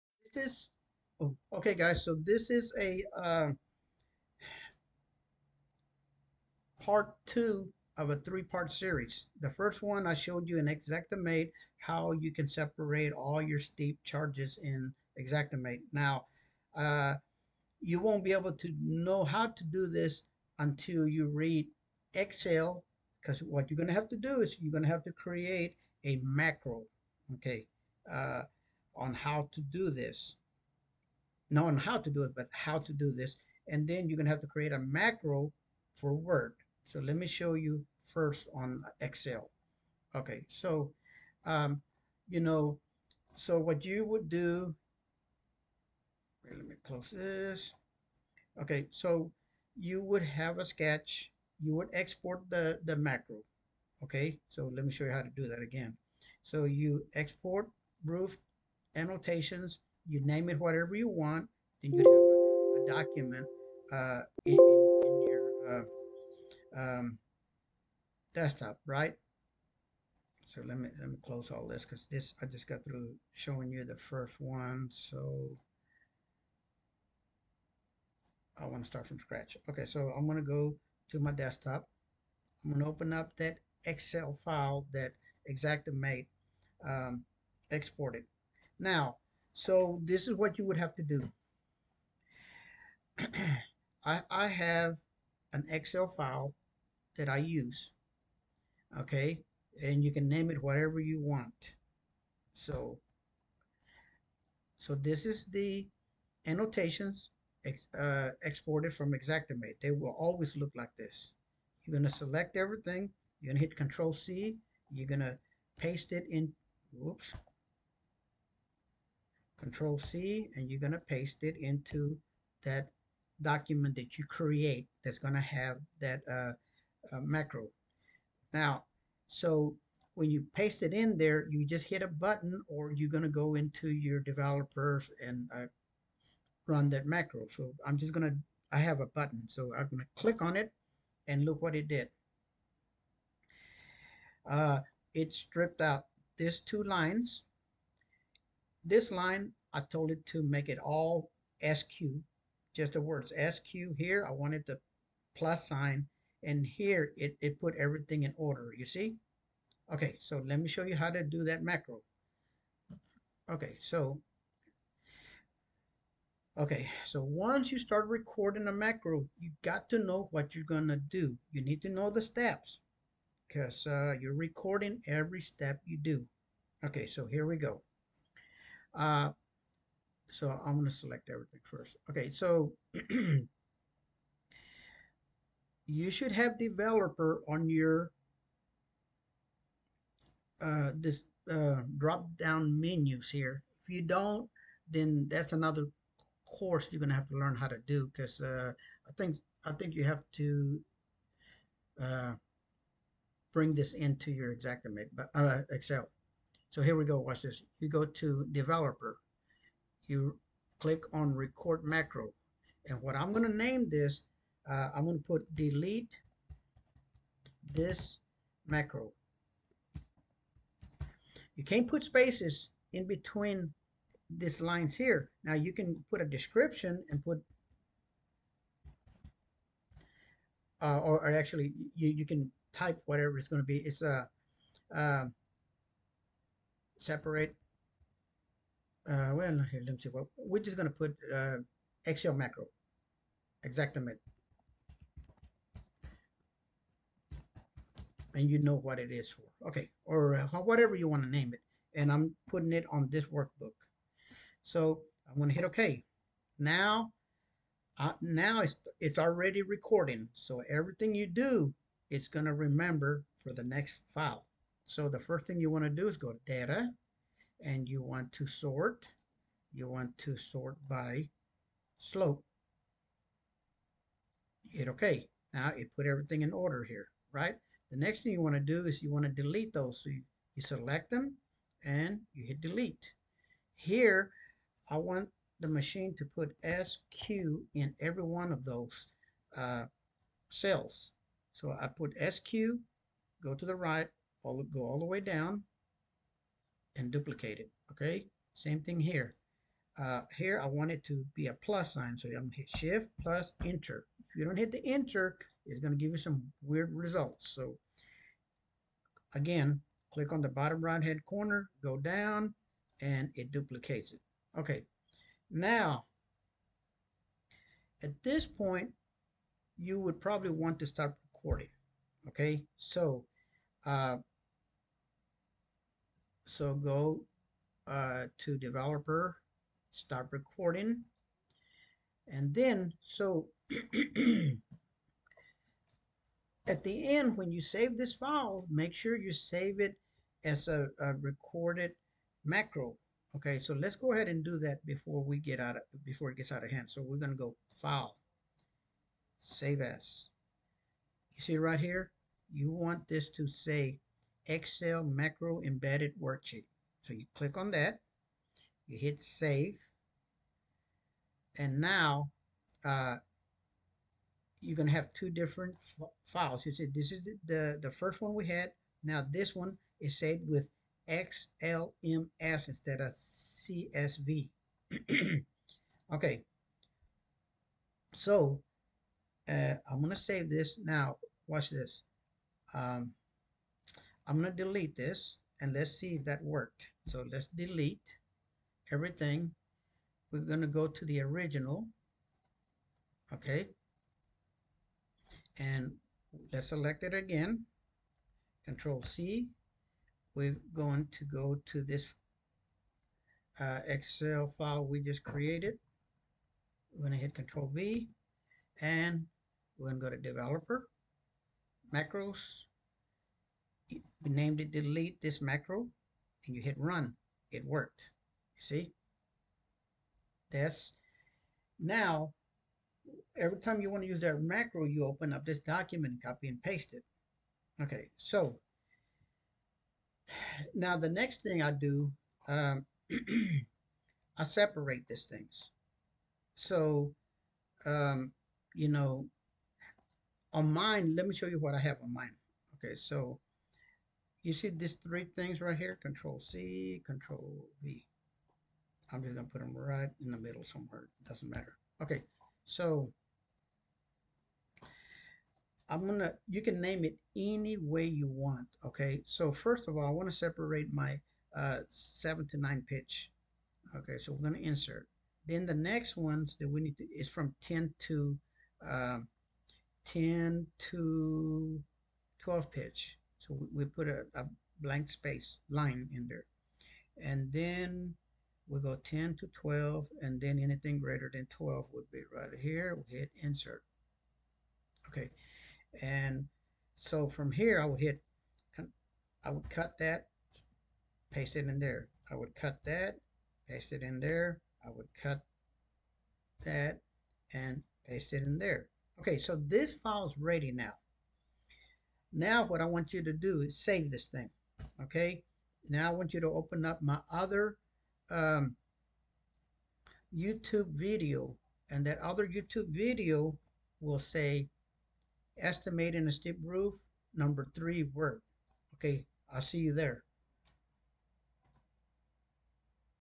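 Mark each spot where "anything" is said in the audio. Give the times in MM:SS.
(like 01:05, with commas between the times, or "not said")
08:00.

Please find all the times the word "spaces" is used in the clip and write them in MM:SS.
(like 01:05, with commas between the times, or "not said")
03:42, 07:55.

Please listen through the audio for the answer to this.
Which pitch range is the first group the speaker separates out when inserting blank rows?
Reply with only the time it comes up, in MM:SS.
07:41.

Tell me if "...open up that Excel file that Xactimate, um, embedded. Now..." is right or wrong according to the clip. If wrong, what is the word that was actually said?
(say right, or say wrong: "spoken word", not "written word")
wrong: "exported", not "embedded".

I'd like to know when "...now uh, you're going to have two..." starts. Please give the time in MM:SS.
06:01.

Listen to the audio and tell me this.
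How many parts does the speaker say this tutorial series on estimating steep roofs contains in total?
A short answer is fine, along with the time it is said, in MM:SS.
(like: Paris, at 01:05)
3, at 00:08.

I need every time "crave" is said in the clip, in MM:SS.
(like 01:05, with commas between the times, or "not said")
not said.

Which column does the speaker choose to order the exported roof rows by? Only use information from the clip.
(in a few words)
Slope.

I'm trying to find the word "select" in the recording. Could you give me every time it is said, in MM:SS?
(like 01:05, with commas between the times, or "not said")
01:52, 03:00, 04:40, 06:36.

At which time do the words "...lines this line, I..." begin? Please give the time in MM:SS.
02:26.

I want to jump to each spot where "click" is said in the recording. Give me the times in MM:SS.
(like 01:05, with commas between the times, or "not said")
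02:20, 03:30, 05:10, 05:57.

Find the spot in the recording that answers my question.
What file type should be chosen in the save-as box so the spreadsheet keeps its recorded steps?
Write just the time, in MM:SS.
05:54.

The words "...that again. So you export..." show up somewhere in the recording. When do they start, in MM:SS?
00:55.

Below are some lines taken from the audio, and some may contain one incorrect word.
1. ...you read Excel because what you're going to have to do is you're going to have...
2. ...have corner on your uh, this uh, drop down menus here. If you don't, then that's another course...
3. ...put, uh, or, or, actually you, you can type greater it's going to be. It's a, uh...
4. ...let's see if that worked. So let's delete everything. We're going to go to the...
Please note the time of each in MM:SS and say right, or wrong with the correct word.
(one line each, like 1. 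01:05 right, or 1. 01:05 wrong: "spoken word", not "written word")
1. 00:21 right
2. 03:06 wrong: "developer", not "corner"
3. 03:47 wrong: "whatever", not "greater"
4. 06:25 right.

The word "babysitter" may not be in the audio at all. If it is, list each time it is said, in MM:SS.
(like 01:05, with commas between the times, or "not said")
not said.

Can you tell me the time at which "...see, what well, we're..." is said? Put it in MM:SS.
03:59.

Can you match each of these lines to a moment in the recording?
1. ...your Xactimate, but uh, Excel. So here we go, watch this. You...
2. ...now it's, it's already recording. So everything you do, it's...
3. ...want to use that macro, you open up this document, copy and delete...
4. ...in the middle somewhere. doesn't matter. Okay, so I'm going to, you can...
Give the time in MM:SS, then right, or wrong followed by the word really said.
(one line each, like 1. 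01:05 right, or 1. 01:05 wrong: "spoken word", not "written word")
1. 03:24 right
2. 04:18 right
3. 07:03 wrong: "paste", not "delete"
4. 07:30 right.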